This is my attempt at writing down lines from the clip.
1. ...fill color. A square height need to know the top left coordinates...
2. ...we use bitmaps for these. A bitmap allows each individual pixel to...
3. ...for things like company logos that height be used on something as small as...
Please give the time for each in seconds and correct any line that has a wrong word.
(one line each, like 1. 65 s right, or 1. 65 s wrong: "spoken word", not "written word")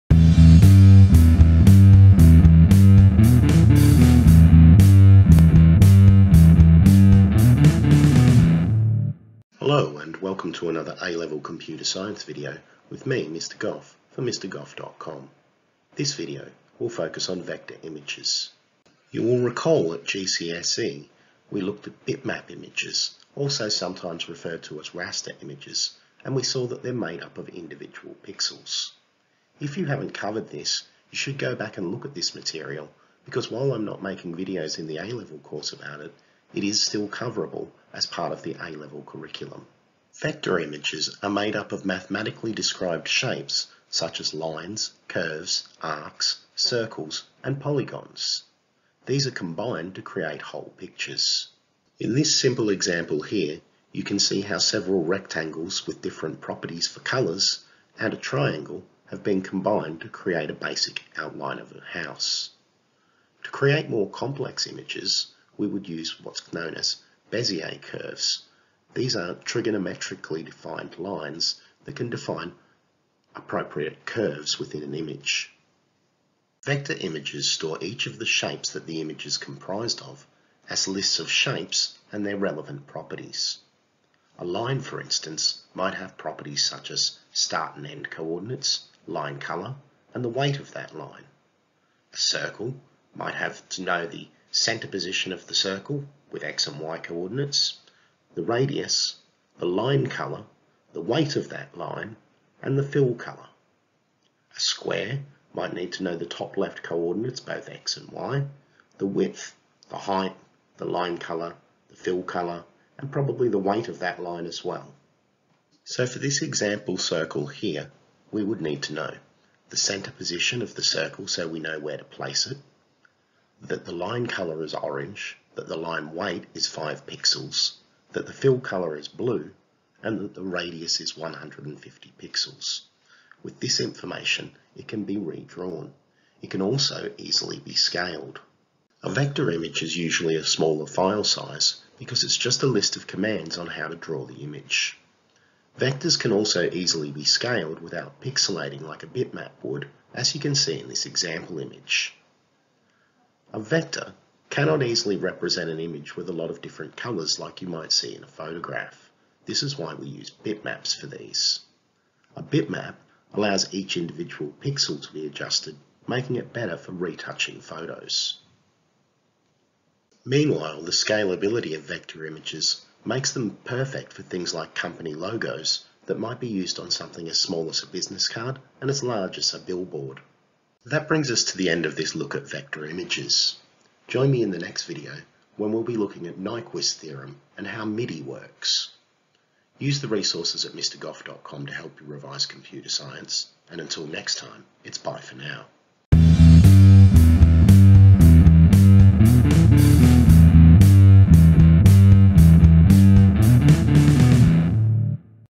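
1. 102 s wrong: "might", not "height"
2. 159 s right
3. 174 s wrong: "might", not "height".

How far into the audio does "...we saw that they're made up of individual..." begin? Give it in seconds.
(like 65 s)
26 s.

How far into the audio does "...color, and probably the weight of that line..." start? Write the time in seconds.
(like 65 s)
112 s.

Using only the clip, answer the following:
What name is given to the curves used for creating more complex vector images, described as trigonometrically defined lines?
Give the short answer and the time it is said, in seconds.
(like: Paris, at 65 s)
Bezier curves, at 67 s.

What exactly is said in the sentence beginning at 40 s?
Vector images are made up of mathematically described shapes such as lines, curves, arcs, circles, and polygons.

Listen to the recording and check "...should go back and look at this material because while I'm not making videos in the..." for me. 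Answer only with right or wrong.
right.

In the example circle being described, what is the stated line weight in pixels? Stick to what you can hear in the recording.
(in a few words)
5 pixels.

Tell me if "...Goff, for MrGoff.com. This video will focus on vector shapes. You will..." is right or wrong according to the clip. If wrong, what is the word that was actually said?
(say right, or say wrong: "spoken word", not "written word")
wrong: "images", not "shapes".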